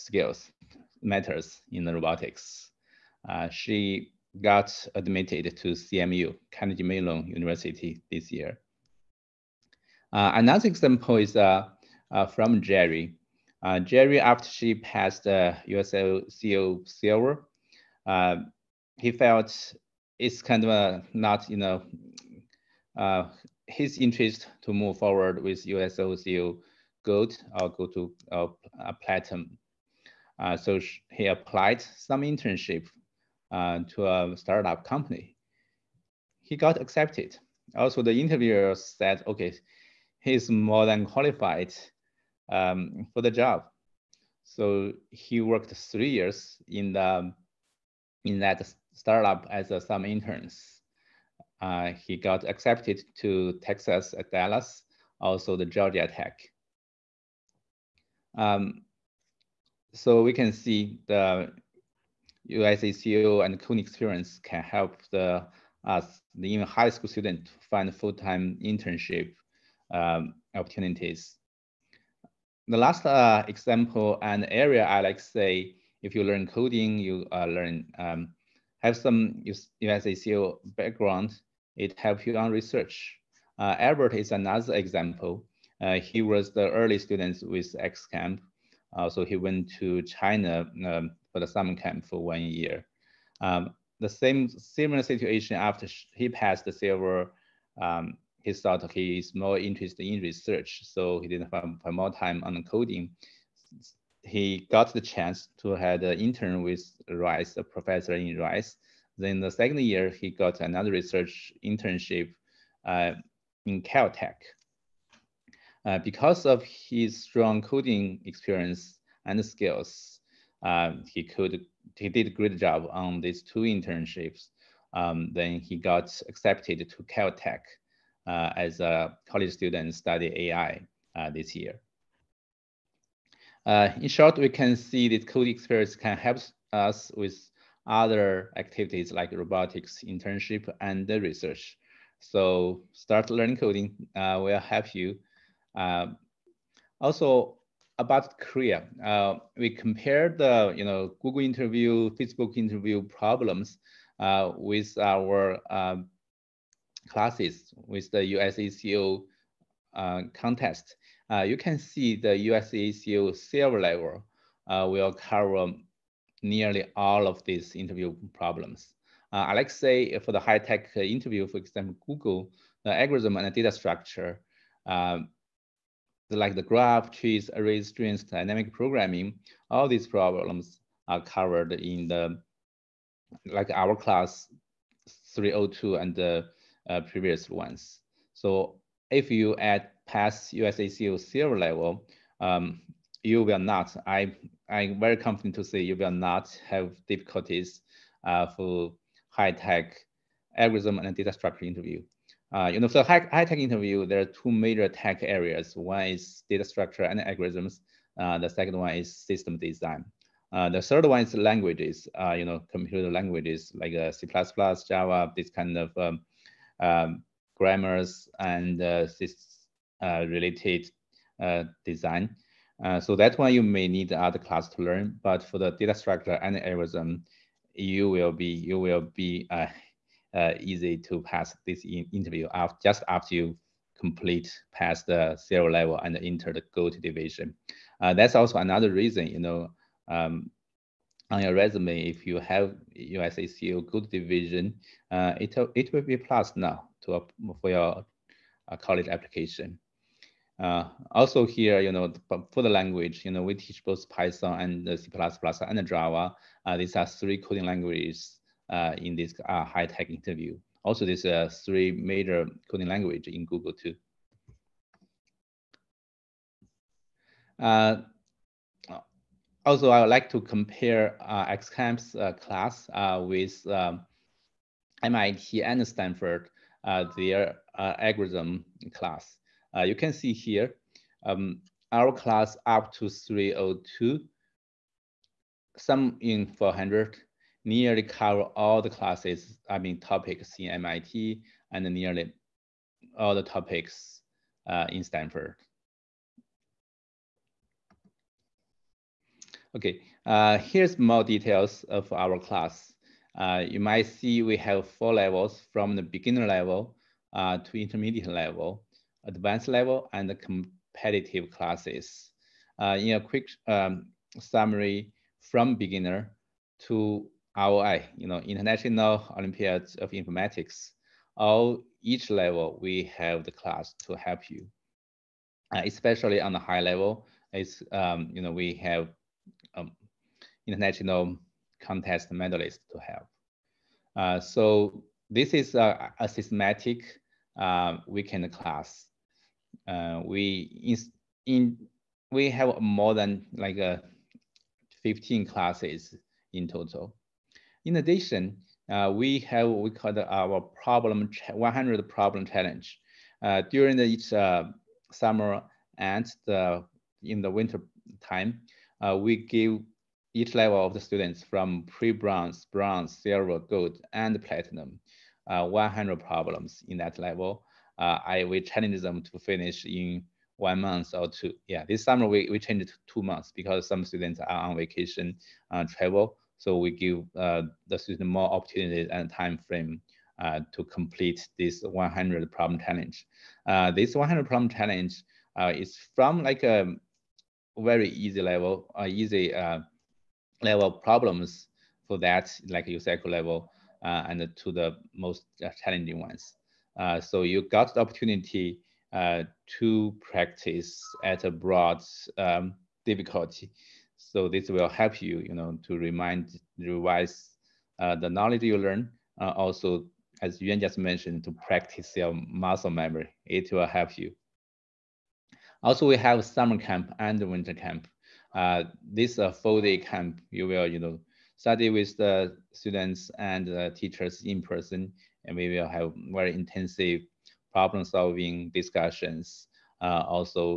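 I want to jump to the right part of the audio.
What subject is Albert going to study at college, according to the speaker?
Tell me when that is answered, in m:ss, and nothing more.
2:10.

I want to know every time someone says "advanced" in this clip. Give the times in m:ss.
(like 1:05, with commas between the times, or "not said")
5:09.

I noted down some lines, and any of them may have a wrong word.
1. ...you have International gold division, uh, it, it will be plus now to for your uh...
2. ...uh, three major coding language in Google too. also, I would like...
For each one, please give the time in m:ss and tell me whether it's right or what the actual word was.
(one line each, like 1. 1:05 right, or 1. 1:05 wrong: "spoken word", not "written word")
1. 4:02 wrong: "USACO", not "International"
2. 4:21 right.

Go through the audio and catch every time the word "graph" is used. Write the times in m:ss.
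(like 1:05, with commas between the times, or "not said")
2:56.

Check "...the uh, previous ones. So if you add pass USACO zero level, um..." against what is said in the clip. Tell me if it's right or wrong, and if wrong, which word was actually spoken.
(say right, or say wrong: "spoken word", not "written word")
right.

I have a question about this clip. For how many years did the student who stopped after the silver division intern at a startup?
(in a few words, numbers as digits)
3.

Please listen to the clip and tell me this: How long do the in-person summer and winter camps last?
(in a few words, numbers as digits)
4 days.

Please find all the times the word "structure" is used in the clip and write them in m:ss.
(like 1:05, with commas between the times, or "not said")
2:53, 3:21, 3:26, 3:45.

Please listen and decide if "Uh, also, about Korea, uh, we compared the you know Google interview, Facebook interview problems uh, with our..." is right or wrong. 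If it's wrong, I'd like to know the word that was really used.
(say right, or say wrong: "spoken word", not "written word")
right.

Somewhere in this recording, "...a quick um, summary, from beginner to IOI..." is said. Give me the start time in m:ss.
5:13.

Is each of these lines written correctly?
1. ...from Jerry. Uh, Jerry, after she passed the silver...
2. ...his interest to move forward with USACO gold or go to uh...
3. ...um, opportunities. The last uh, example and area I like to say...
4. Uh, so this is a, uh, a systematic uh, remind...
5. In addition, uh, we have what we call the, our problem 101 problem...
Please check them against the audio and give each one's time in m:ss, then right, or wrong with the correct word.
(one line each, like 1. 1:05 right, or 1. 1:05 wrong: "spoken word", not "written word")
1. 0:12 right
2. 0:23 right
3. 1:09 right
4. 5:34 wrong: "weekend", not "remind"
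5. 5:47 wrong: "100", not "101".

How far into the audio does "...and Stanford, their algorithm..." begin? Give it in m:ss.
4:35.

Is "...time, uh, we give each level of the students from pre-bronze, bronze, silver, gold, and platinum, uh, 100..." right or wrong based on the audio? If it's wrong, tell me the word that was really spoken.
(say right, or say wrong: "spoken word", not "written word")
right.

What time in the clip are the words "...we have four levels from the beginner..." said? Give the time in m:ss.
5:04.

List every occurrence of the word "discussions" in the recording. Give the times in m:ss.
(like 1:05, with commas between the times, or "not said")
7:08.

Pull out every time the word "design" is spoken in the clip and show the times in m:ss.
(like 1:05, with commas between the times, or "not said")
3:29, 3:41.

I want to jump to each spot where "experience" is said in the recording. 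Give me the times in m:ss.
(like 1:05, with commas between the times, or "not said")
1:03, 1:58, 2:15.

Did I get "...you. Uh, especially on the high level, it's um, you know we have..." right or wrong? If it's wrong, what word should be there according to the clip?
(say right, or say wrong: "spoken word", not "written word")
right.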